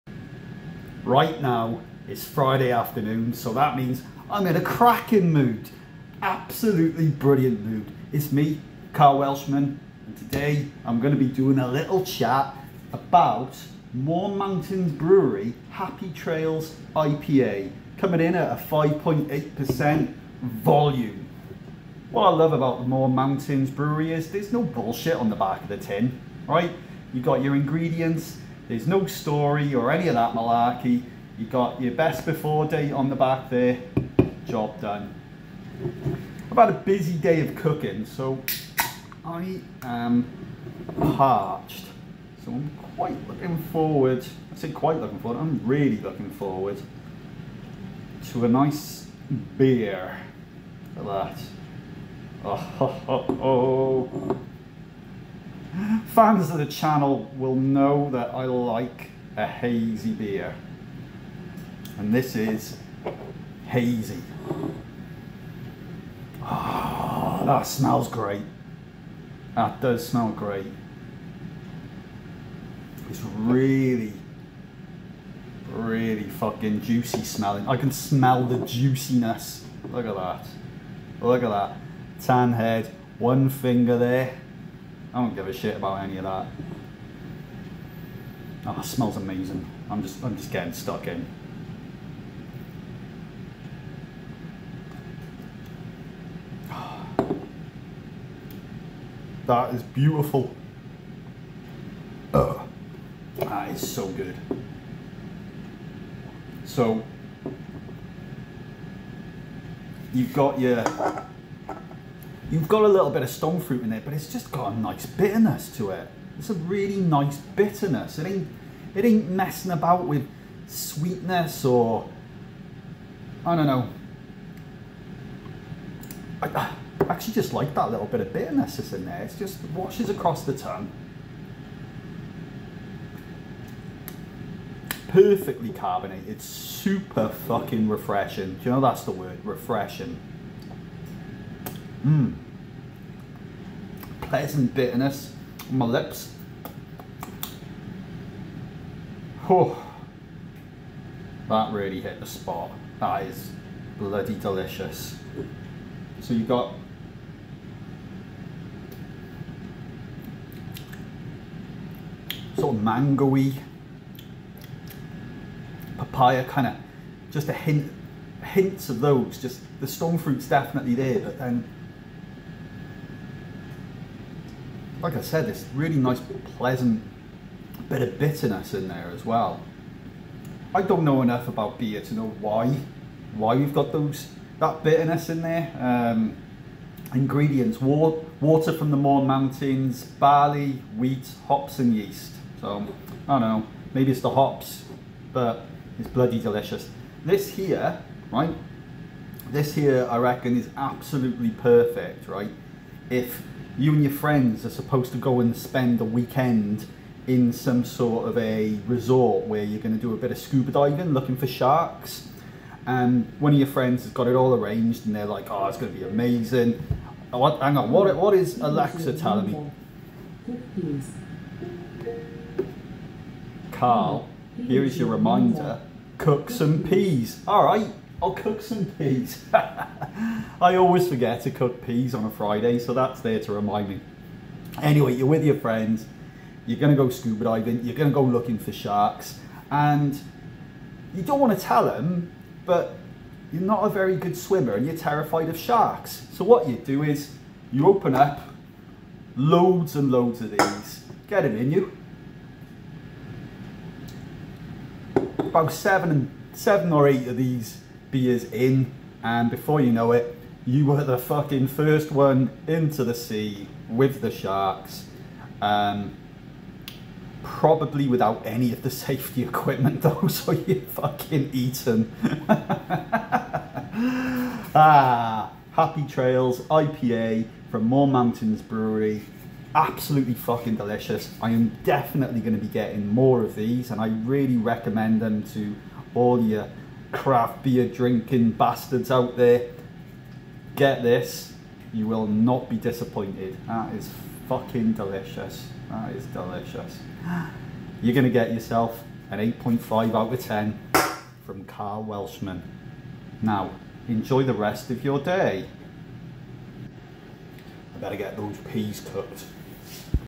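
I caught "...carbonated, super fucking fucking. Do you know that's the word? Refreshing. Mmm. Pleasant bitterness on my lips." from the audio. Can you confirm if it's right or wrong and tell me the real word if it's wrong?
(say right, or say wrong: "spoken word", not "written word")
wrong: "refreshing", not "fucking".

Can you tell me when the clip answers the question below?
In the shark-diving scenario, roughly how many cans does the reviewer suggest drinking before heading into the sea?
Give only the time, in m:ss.
4:16.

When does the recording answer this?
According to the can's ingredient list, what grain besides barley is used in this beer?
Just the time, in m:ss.
3:10.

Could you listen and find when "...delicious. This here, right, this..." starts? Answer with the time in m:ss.
3:16.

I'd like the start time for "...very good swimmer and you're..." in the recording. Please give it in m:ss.
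4:03.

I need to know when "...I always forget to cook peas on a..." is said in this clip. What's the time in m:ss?
3:49.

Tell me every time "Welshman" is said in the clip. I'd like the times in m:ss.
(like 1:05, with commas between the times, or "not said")
0:09, 5:02.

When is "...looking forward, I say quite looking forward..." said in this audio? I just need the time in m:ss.
0:43.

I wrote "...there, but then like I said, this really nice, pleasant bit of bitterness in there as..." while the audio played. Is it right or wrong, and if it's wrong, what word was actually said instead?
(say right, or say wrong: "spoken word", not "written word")
right.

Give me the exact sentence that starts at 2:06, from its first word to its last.
I, I actually just like that little bit of bitterness that's in there.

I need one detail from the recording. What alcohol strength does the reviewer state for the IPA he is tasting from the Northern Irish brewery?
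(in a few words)
5.8%.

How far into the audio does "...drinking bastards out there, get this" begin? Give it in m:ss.
4:47.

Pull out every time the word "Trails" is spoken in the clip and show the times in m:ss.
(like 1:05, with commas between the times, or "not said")
0:16, 4:36.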